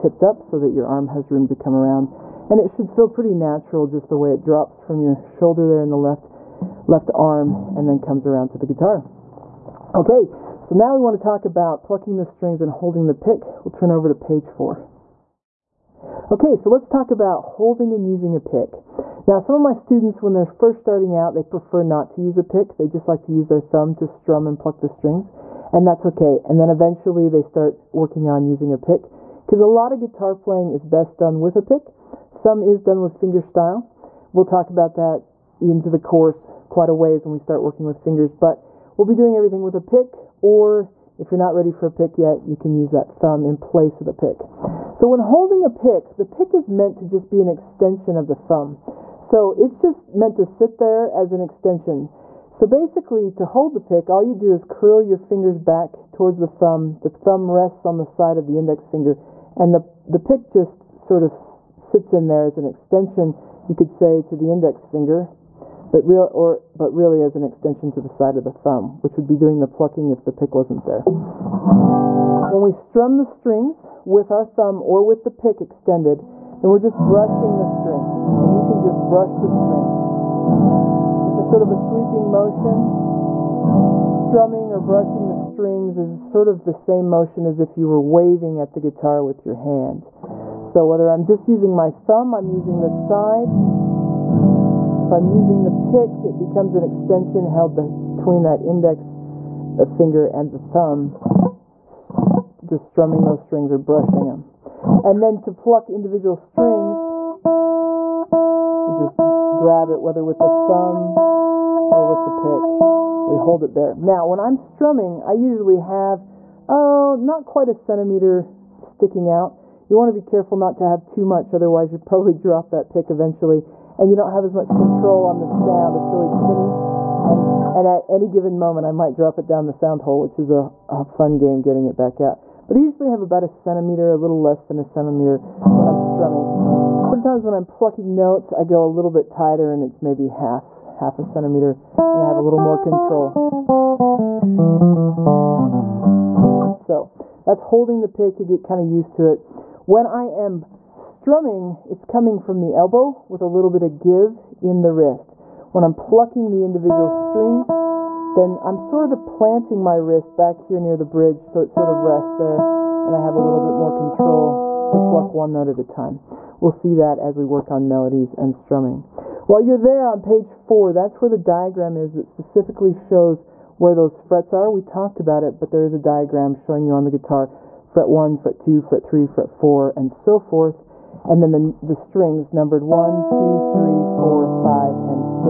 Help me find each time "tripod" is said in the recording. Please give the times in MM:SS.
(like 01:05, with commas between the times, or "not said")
not said.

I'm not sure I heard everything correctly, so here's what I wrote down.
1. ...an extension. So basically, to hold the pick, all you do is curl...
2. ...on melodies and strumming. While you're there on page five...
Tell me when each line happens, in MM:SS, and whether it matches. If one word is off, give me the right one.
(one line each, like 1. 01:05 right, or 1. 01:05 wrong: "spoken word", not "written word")
1. 00:51 right
2. 02:47 wrong: "four", not "five".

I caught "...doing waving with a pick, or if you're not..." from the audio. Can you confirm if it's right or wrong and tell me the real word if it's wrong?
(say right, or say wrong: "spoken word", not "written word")
wrong: "everything", not "waving".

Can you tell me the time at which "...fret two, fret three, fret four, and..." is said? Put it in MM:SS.
02:58.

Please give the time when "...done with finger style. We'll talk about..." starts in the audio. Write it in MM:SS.
00:32.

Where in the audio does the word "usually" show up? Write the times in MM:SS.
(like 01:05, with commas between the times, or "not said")
01:55, 02:12.